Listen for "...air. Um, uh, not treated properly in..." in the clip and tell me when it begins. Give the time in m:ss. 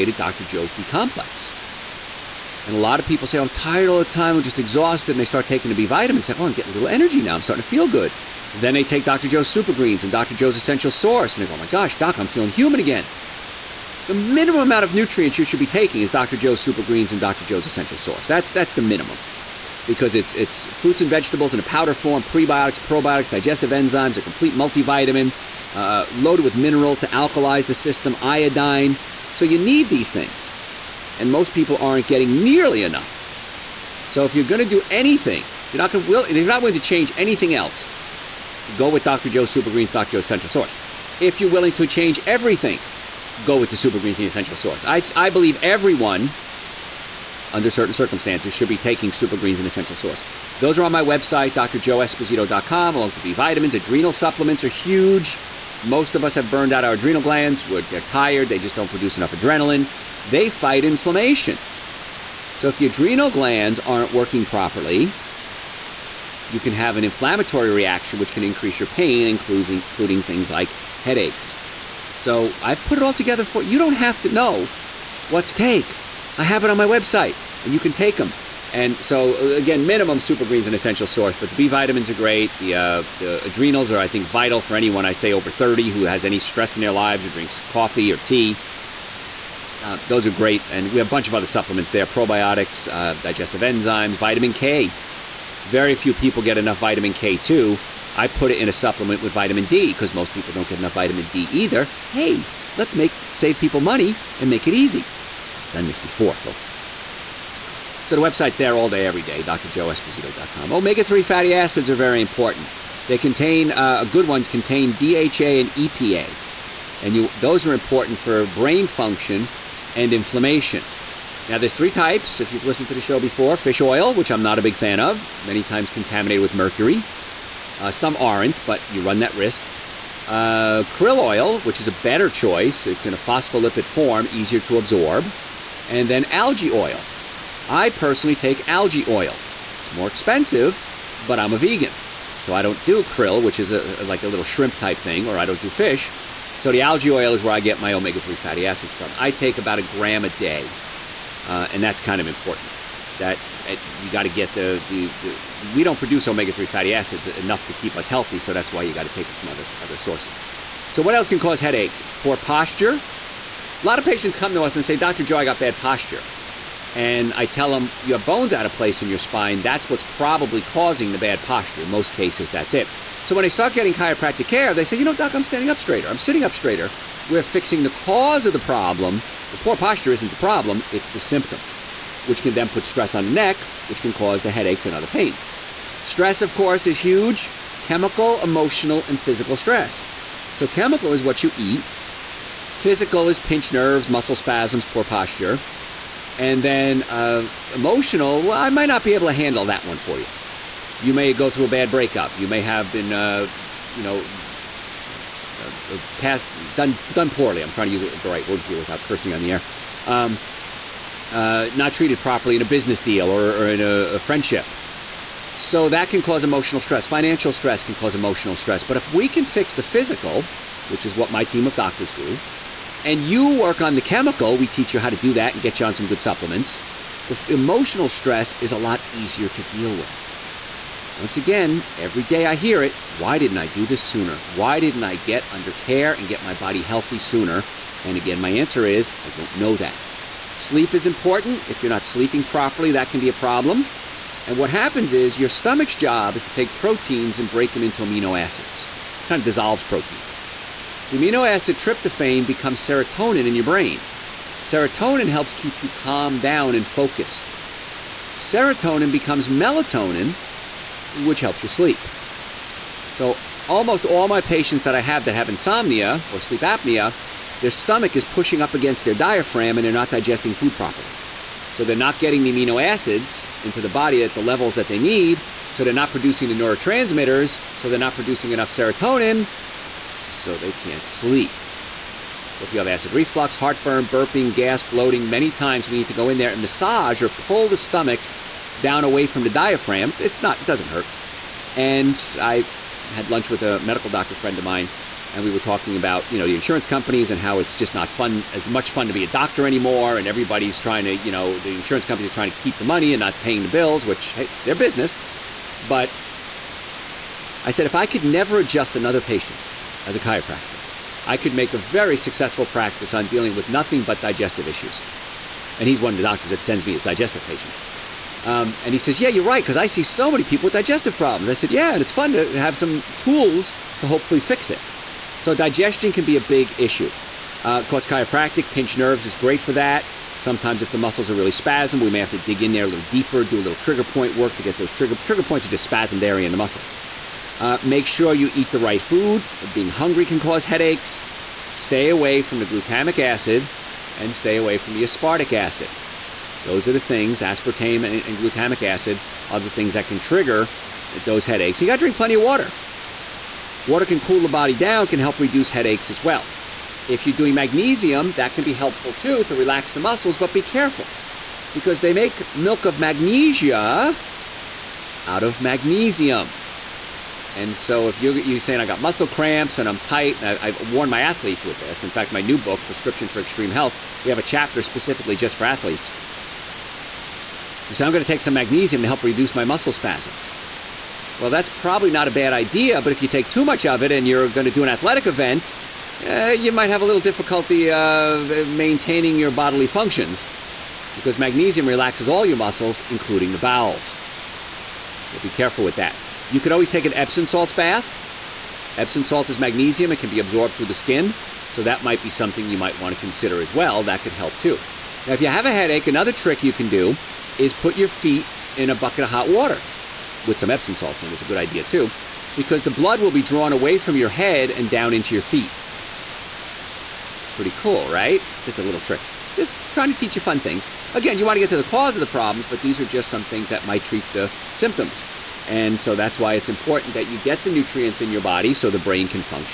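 3:29.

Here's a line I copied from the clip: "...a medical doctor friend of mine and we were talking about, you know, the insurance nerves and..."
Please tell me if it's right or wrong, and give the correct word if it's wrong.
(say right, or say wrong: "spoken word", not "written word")
wrong: "companies", not "nerves".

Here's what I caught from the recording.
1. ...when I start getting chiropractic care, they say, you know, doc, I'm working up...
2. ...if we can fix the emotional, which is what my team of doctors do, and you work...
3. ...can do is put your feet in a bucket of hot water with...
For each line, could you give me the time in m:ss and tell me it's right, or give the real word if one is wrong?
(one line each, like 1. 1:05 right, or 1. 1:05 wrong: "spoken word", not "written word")
1. 2:53 wrong: "standing", not "working"
2. 3:38 wrong: "physical", not "emotional"
3. 6:46 right.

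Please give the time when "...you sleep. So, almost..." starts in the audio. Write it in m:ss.
4:21.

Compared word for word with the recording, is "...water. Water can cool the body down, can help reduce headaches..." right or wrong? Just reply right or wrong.
right.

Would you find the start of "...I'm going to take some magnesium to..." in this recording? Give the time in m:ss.
6:18.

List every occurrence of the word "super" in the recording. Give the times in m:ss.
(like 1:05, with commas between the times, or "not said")
0:09, 0:16, 0:39, 0:43, 0:49, 1:20.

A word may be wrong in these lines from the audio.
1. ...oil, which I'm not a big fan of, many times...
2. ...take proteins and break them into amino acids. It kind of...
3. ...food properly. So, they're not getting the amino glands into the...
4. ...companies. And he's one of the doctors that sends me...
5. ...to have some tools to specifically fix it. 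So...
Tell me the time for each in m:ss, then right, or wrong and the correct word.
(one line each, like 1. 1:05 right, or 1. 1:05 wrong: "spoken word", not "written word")
1. 2:03 right
2. 4:06 right
3. 4:30 wrong: "acids", not "glands"
4. 5:14 wrong: "issues", not "companies"
5. 5:22 wrong: "hopefully", not "specifically".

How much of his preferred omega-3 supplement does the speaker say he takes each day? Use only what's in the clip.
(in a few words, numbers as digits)
about a gram.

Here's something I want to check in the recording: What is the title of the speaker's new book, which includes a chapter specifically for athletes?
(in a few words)
Prescription for Extreme Health.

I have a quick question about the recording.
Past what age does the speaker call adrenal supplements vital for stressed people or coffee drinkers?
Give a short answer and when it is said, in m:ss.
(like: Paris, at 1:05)
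30, at 1:25.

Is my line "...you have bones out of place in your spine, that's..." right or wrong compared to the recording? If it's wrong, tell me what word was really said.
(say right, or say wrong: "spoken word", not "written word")
right.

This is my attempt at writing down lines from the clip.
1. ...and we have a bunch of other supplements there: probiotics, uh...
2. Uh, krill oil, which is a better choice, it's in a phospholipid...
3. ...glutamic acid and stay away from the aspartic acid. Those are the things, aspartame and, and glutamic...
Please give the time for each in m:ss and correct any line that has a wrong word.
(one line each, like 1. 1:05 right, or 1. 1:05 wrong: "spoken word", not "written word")
1. 1:30 right
2. 2:10 right
3. 5:42 right.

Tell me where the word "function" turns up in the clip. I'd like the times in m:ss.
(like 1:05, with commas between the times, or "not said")
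1:58, 6:29.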